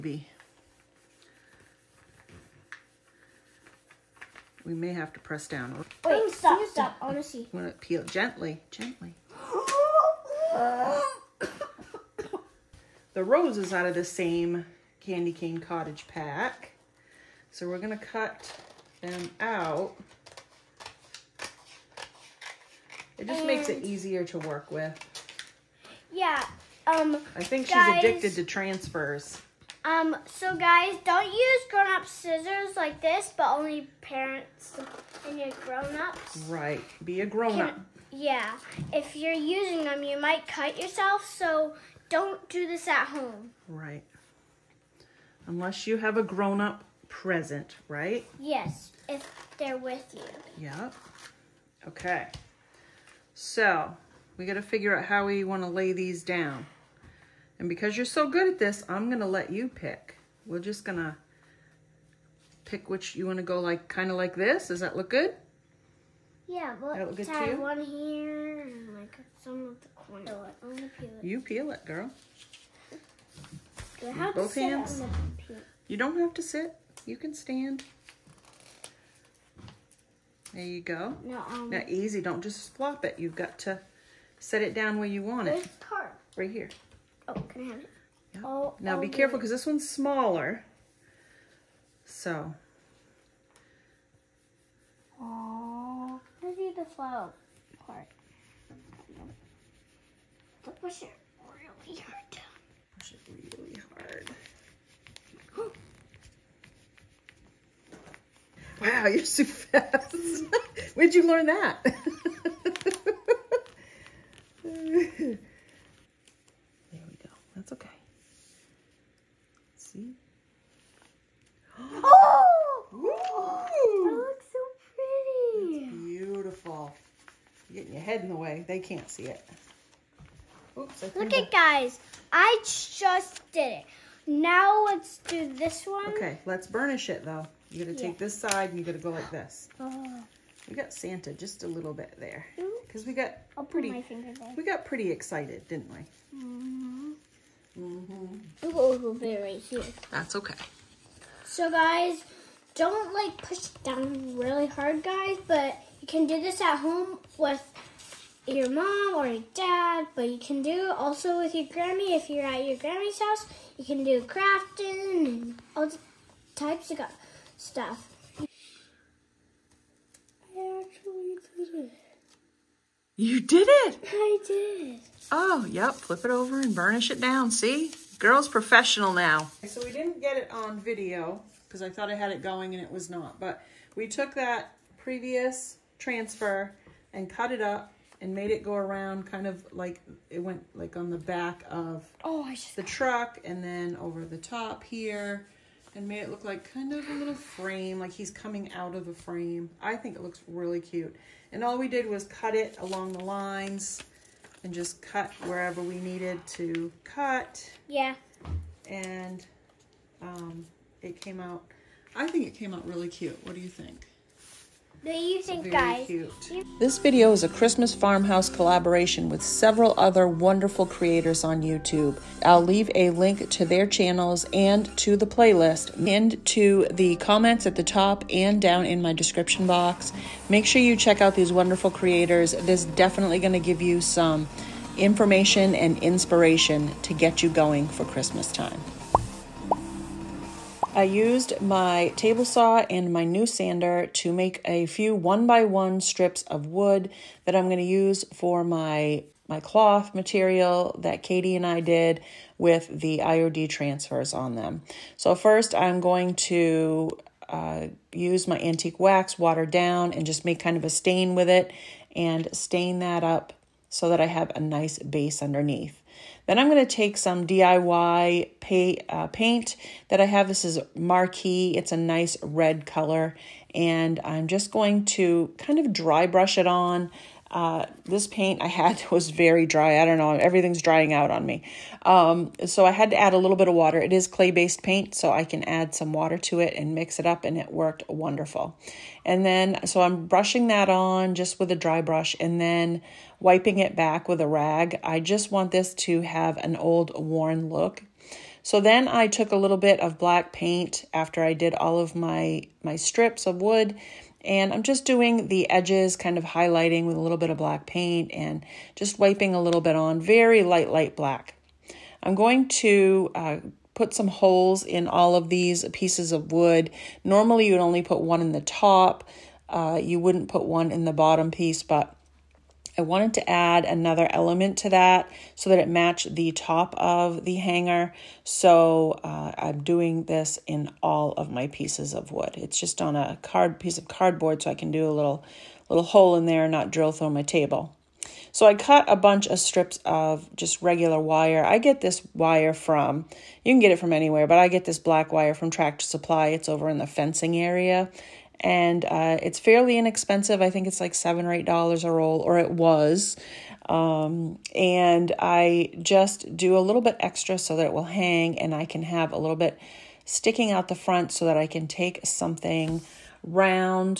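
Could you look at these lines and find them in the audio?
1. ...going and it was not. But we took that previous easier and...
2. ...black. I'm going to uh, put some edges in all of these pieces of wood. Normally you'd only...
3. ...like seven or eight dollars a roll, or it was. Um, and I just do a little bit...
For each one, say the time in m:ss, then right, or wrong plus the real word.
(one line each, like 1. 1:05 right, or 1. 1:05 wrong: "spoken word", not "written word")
1. 3:02 wrong: "transfer", not "easier"
2. 5:11 wrong: "holes", not "edges"
3. 5:51 right.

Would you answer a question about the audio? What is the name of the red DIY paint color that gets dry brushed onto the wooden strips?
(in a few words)
Marquee.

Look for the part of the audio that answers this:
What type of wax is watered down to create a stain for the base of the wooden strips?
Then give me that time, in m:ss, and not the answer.
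4:18.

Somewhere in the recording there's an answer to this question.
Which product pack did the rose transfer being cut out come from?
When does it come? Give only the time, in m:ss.
0:15.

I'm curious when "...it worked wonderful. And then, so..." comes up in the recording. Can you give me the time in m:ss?
4:47.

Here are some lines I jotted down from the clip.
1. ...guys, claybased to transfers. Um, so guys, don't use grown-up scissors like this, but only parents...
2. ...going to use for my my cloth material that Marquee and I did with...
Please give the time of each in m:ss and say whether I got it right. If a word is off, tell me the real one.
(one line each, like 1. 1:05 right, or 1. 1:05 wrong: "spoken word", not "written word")
1. 0:27 wrong: "addicted", not "claybased"
2. 4:07 wrong: "Katie", not "Marquee".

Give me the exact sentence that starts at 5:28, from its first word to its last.
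So uh, I'm doing this in all of my pieces of wood.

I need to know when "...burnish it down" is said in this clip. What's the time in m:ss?
2:56.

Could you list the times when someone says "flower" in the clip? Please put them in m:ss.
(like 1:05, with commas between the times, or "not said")
1:36.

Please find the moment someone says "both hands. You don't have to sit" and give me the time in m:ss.
1:14.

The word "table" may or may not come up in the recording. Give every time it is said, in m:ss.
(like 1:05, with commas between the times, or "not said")
4:02, 5:37.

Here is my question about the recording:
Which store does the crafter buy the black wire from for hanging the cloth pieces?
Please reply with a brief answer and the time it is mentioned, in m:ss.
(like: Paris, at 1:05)
Tractor Supply, at 5:45.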